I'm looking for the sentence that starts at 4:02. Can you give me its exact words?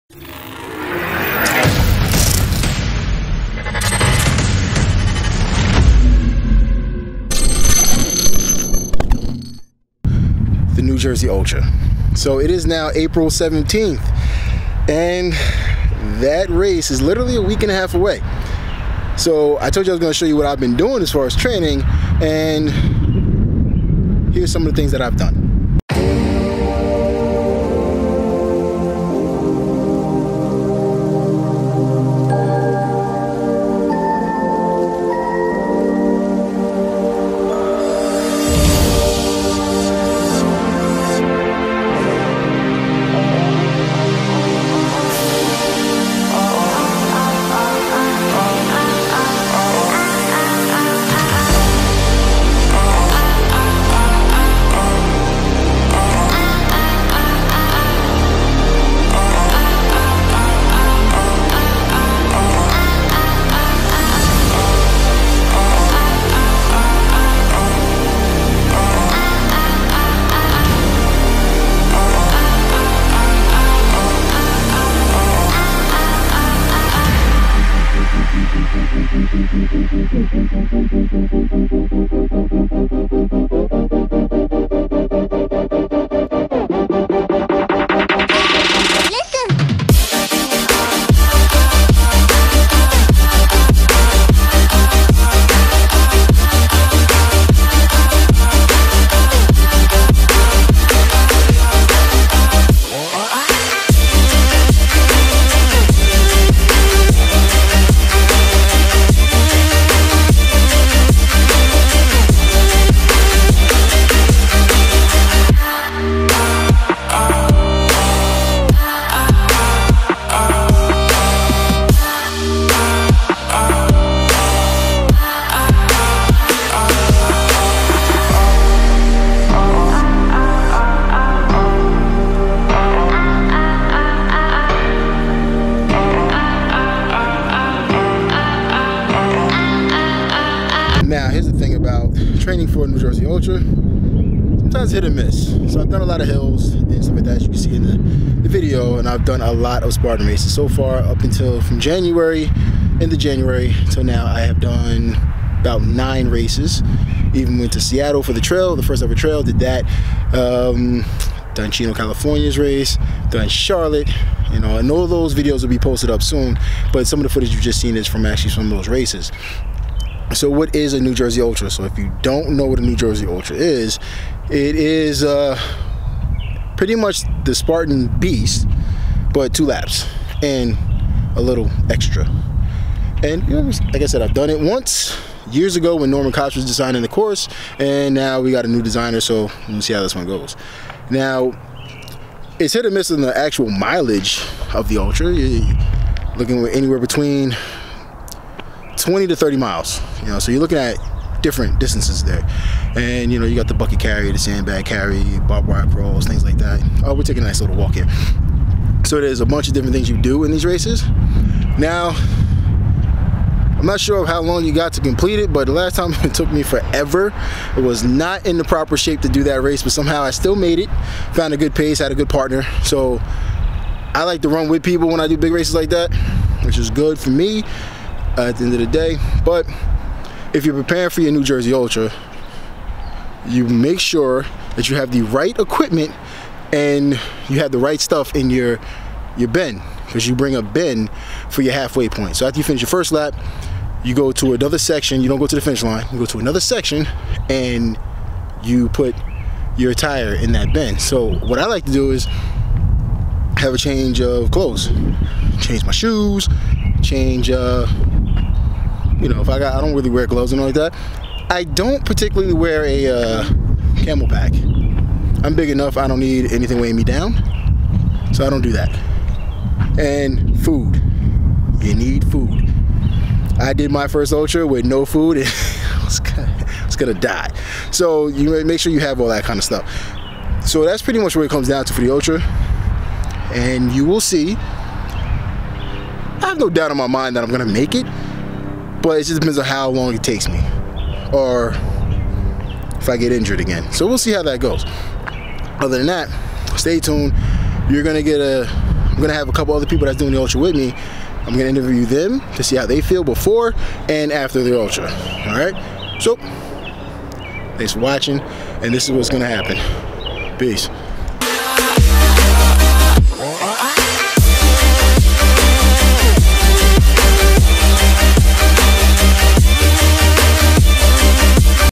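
So after you finish your first lap, you go to another section.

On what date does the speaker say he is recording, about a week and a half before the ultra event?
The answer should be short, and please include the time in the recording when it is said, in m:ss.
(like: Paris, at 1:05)
April 17th, at 0:12.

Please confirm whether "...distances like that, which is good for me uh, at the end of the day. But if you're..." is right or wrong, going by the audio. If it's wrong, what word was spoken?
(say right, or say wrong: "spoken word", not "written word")
wrong: "races", not "distances".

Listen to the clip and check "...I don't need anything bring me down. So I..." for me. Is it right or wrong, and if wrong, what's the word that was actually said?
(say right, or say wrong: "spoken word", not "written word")
wrong: "weighing", not "bring".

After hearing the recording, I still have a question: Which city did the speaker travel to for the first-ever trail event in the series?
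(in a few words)
Seattle.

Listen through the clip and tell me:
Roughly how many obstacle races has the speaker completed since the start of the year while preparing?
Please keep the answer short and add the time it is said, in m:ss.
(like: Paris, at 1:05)
9, at 2:35.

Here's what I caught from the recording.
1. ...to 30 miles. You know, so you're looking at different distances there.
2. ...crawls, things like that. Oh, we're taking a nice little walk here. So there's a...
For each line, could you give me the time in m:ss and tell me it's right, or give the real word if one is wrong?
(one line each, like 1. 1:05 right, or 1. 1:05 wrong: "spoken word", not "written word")
1. 3:19 right
2. 3:25 right.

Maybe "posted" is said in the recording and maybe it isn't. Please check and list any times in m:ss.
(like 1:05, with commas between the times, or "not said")
2:45.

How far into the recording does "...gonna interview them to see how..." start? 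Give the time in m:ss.
5:01.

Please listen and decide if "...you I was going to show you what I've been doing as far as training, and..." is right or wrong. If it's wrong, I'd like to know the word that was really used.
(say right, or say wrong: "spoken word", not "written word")
right.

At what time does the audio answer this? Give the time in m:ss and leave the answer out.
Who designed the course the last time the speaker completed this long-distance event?
3:06.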